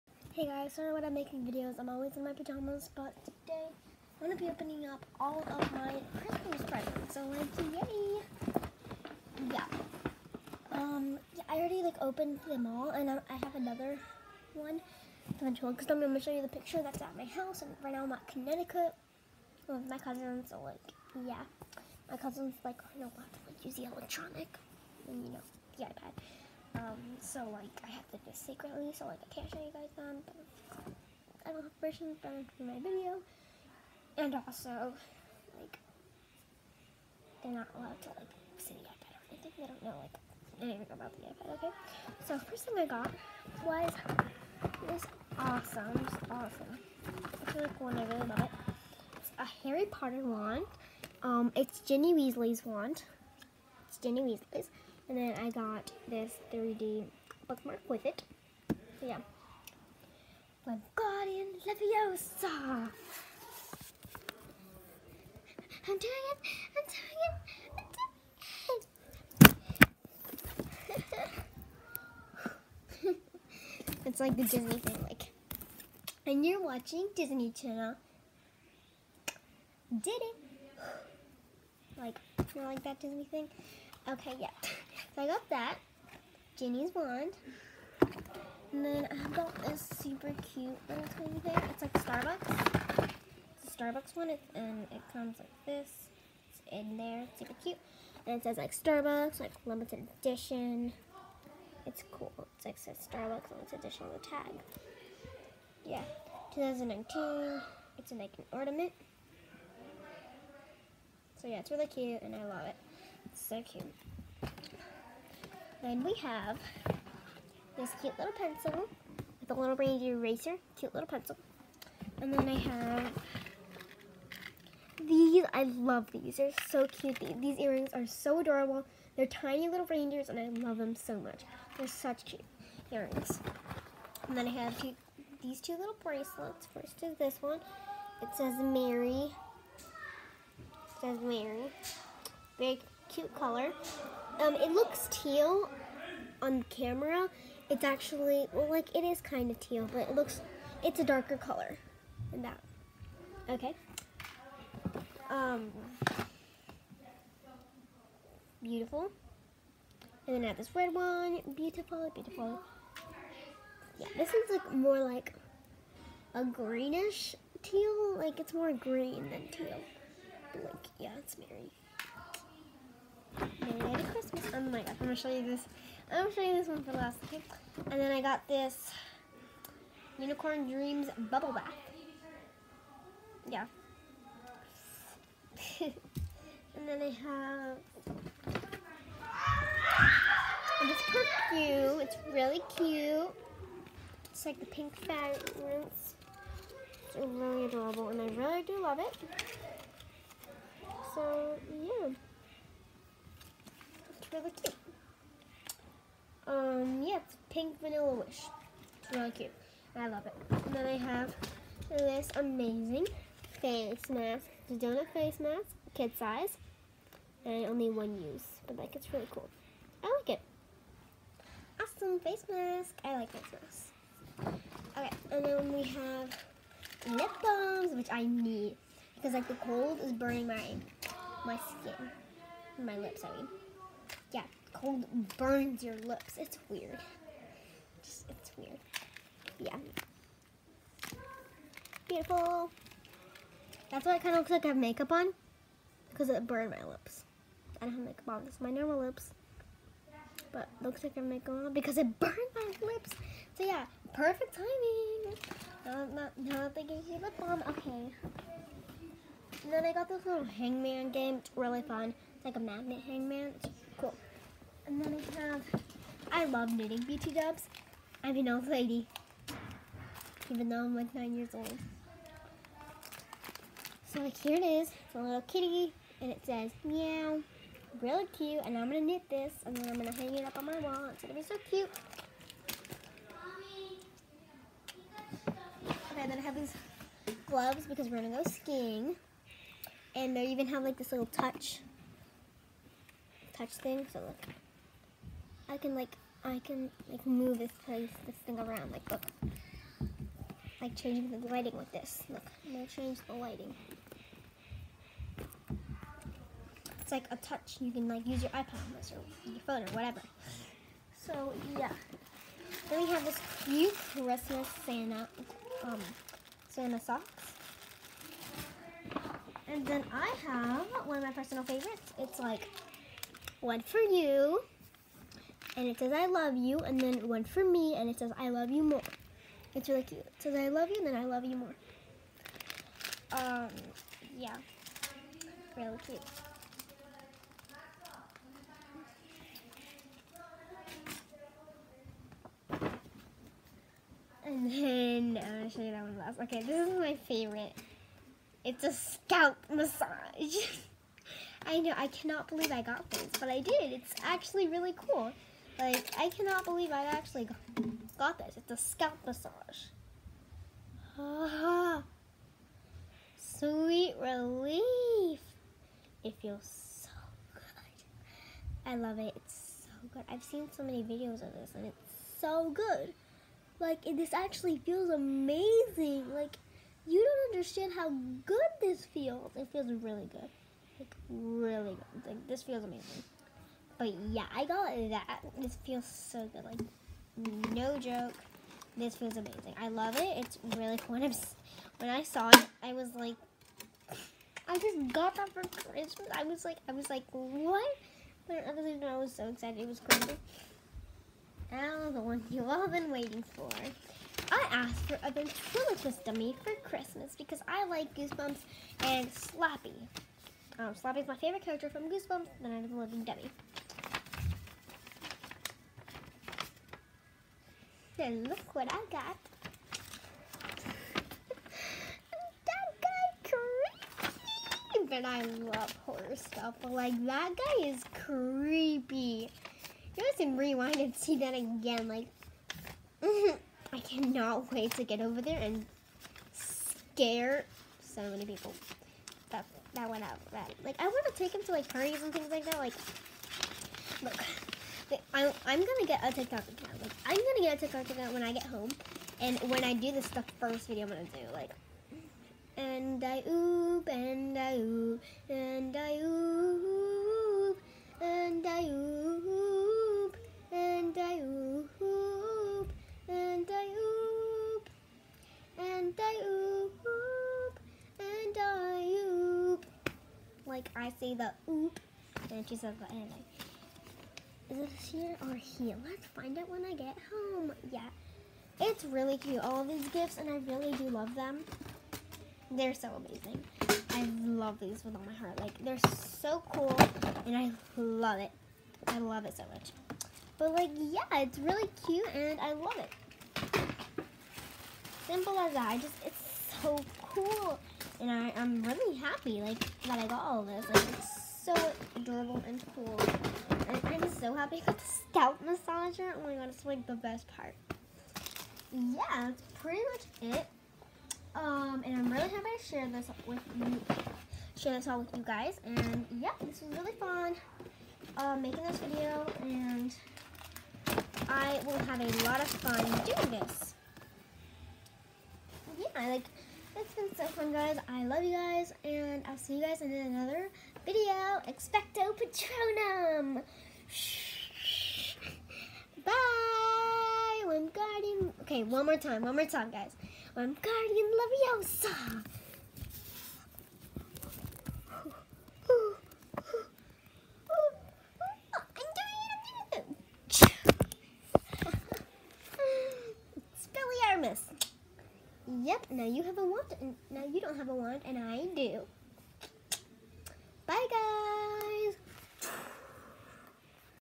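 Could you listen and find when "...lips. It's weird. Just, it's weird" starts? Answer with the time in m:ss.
3:55.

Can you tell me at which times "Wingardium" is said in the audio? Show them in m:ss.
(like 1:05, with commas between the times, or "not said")
1:00, 8:57.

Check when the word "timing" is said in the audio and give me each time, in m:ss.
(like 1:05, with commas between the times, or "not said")
4:14.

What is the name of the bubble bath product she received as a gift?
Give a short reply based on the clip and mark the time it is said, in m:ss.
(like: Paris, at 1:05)
Unicorn Dreams, at 3:00.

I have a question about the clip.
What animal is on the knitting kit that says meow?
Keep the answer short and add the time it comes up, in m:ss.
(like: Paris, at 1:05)
Kitty, at 4:35.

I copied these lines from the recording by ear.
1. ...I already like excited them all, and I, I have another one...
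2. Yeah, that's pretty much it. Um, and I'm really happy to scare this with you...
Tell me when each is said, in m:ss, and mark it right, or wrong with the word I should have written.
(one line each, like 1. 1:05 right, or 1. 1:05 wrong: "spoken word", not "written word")
1. 0:11 wrong: "opened", not "excited"
2. 8:28 wrong: "share", not "scare".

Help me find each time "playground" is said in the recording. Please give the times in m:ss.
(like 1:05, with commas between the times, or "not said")
not said.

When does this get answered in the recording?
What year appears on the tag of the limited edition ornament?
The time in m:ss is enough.
1:46.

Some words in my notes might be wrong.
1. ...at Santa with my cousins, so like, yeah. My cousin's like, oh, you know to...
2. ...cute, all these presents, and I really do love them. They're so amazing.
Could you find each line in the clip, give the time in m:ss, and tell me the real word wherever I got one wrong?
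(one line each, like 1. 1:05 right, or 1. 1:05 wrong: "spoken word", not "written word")
1. 0:18 wrong: "Connecticut", not "Santa"
2. 7:59 wrong: "gifts", not "presents".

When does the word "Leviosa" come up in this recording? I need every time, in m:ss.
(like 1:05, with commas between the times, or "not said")
1:01, 9:01.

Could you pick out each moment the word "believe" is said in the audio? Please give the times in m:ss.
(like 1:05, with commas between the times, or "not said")
5:52, 5:56.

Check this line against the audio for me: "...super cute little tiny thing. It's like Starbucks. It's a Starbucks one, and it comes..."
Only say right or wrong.
right.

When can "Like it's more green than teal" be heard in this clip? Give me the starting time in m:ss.
2:48.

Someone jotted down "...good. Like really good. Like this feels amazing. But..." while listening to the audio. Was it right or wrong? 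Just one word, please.
right.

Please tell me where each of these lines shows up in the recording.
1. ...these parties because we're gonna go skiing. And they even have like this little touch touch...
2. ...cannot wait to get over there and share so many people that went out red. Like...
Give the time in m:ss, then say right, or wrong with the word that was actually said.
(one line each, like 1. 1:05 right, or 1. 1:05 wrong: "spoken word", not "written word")
1. 4:46 wrong: "gloves", not "parties"
2. 7:13 wrong: "scare", not "share".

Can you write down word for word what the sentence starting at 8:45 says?
Yeah, like it's been so fun, guys.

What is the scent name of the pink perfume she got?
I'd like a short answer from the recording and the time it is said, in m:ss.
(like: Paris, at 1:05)
Pink Vanilla Wish, at 3:27.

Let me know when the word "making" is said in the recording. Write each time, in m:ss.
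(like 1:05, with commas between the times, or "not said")
0:01, 8:38.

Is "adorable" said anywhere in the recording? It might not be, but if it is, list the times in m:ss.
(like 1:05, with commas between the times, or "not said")
2:08, 3:17, 8:22.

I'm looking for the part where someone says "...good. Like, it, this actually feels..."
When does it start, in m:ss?
6:12.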